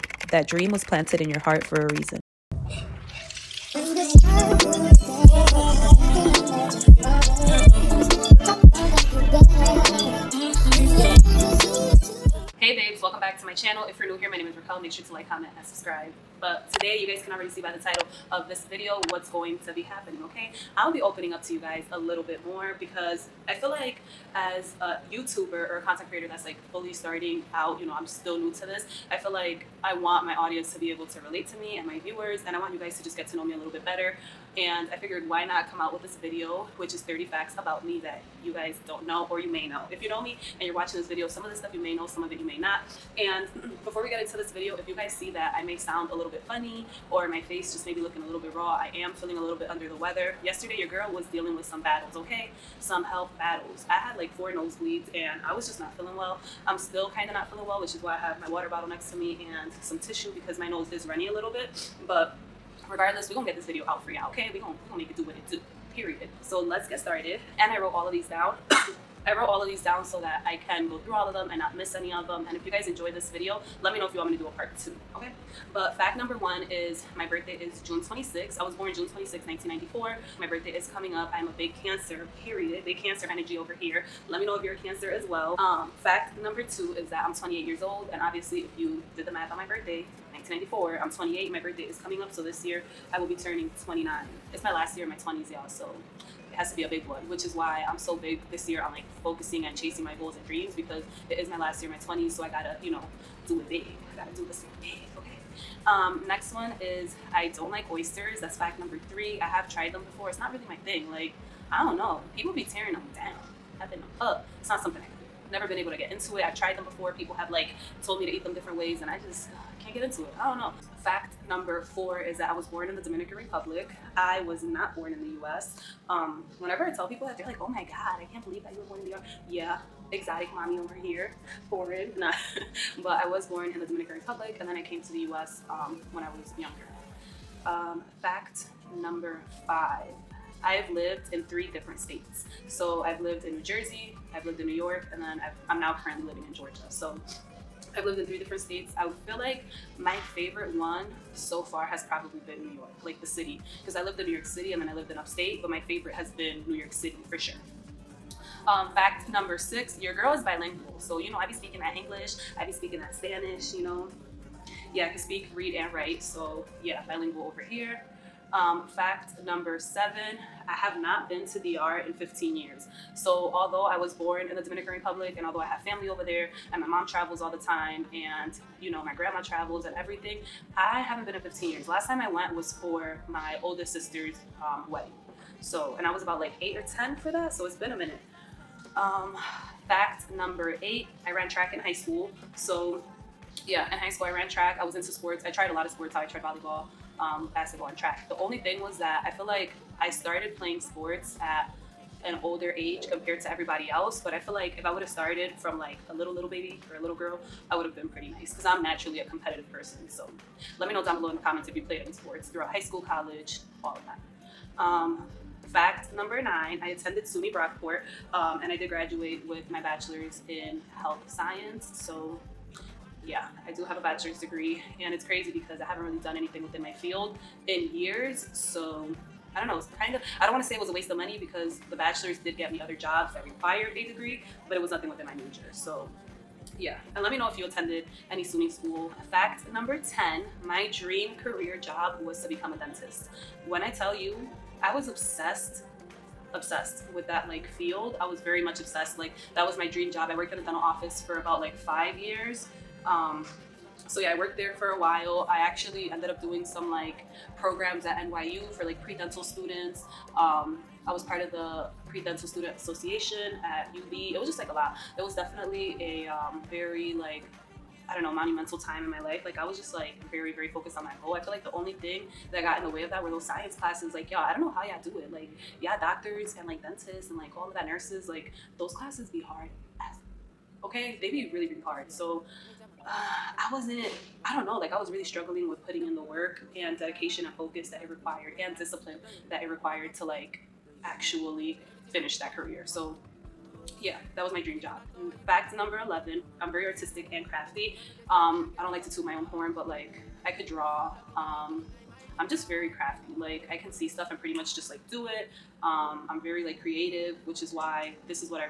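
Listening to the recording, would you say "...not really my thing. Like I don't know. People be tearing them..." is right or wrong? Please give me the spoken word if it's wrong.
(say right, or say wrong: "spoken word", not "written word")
right.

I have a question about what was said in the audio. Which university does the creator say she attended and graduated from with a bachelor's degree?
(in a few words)
SUNY Brockport.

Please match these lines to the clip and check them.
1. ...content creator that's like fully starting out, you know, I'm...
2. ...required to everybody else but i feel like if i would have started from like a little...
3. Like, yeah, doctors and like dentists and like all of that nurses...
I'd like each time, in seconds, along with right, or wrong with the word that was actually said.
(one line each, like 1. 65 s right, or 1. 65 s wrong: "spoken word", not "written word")
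1. 25 s right
2. 203 s wrong: "compared", not "required"
3. 275 s right.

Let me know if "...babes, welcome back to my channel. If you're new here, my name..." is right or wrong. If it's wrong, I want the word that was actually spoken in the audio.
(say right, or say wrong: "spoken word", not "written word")
right.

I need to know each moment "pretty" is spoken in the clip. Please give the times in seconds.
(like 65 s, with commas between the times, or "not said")
208 s, 304 s.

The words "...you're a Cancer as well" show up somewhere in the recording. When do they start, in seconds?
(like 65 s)
84 s.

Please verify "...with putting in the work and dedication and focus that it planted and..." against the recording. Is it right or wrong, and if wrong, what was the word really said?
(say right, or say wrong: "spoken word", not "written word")
wrong: "required", not "planted".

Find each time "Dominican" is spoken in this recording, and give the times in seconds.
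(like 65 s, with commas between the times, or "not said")
123 s, 133 s, 174 s.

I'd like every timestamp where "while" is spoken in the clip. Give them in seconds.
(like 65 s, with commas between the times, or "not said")
255 s.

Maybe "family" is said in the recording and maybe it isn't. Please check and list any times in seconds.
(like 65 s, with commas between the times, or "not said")
175 s.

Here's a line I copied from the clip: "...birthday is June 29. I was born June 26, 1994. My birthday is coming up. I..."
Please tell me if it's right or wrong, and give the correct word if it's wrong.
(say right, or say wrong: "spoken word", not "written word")
wrong: "26", not "29".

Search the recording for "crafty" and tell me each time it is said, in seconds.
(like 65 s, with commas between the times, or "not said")
297 s, 302 s.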